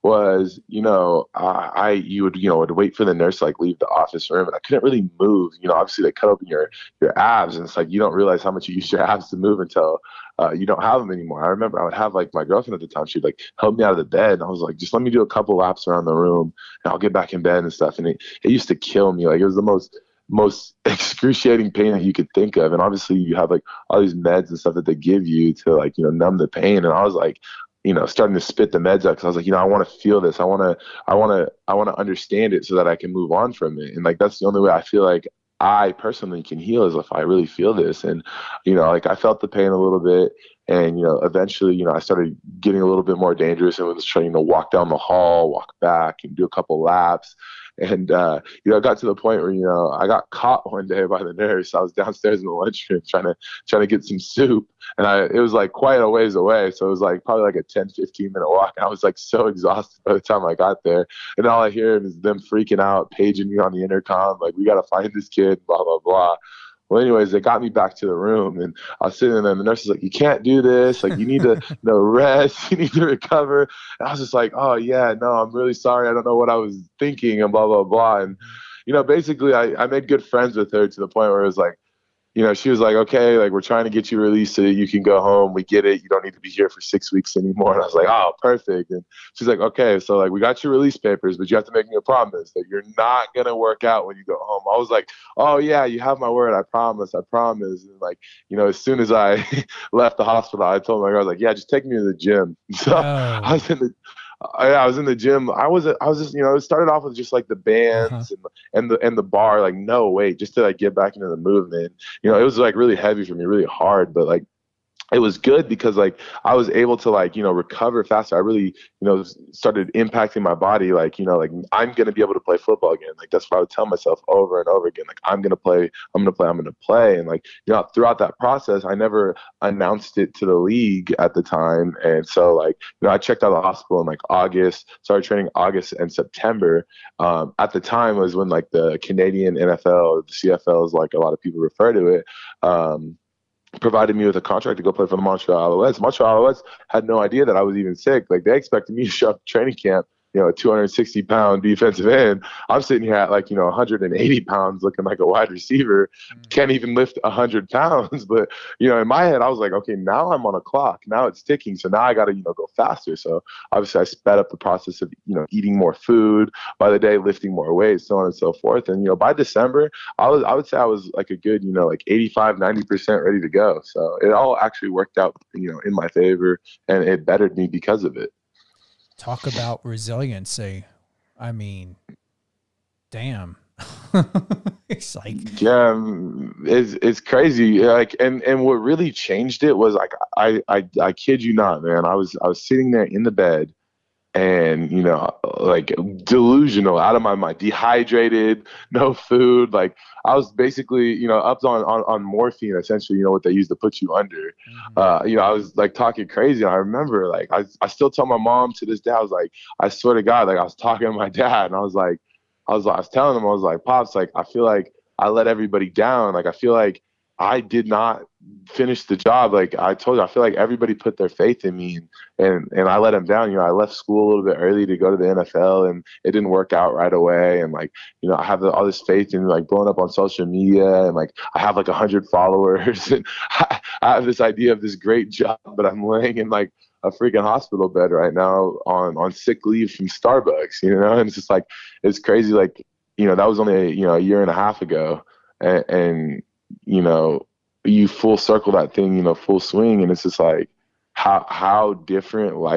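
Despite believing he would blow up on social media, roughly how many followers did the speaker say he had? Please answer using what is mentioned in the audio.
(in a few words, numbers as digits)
100.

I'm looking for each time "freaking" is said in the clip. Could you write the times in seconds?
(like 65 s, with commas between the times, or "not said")
62 s, 237 s.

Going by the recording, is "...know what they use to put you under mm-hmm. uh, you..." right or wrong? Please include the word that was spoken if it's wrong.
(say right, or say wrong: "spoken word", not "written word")
right.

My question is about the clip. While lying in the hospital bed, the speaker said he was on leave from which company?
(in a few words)
Starbucks.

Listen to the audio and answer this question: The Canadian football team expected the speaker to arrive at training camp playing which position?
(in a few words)
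Defensive end.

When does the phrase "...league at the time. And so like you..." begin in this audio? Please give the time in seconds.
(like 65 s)
130 s.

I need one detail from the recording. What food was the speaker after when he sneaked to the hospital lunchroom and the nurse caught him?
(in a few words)
Soup.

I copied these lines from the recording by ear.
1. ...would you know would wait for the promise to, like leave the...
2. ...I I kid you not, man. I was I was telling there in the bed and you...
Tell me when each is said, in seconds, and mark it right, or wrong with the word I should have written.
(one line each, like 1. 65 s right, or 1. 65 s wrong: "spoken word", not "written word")
1. 2 s wrong: "nurse", not "promise"
2. 190 s wrong: "sitting", not "telling".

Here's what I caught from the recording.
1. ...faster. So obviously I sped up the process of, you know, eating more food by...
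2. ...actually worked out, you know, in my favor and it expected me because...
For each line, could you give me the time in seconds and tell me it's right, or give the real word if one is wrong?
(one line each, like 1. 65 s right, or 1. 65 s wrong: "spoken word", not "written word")
1. 162 s right
2. 174 s wrong: "bettered", not "expected".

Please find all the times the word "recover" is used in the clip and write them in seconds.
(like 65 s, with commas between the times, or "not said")
73 s, 117 s.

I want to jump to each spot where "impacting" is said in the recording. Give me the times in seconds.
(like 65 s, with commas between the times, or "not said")
119 s.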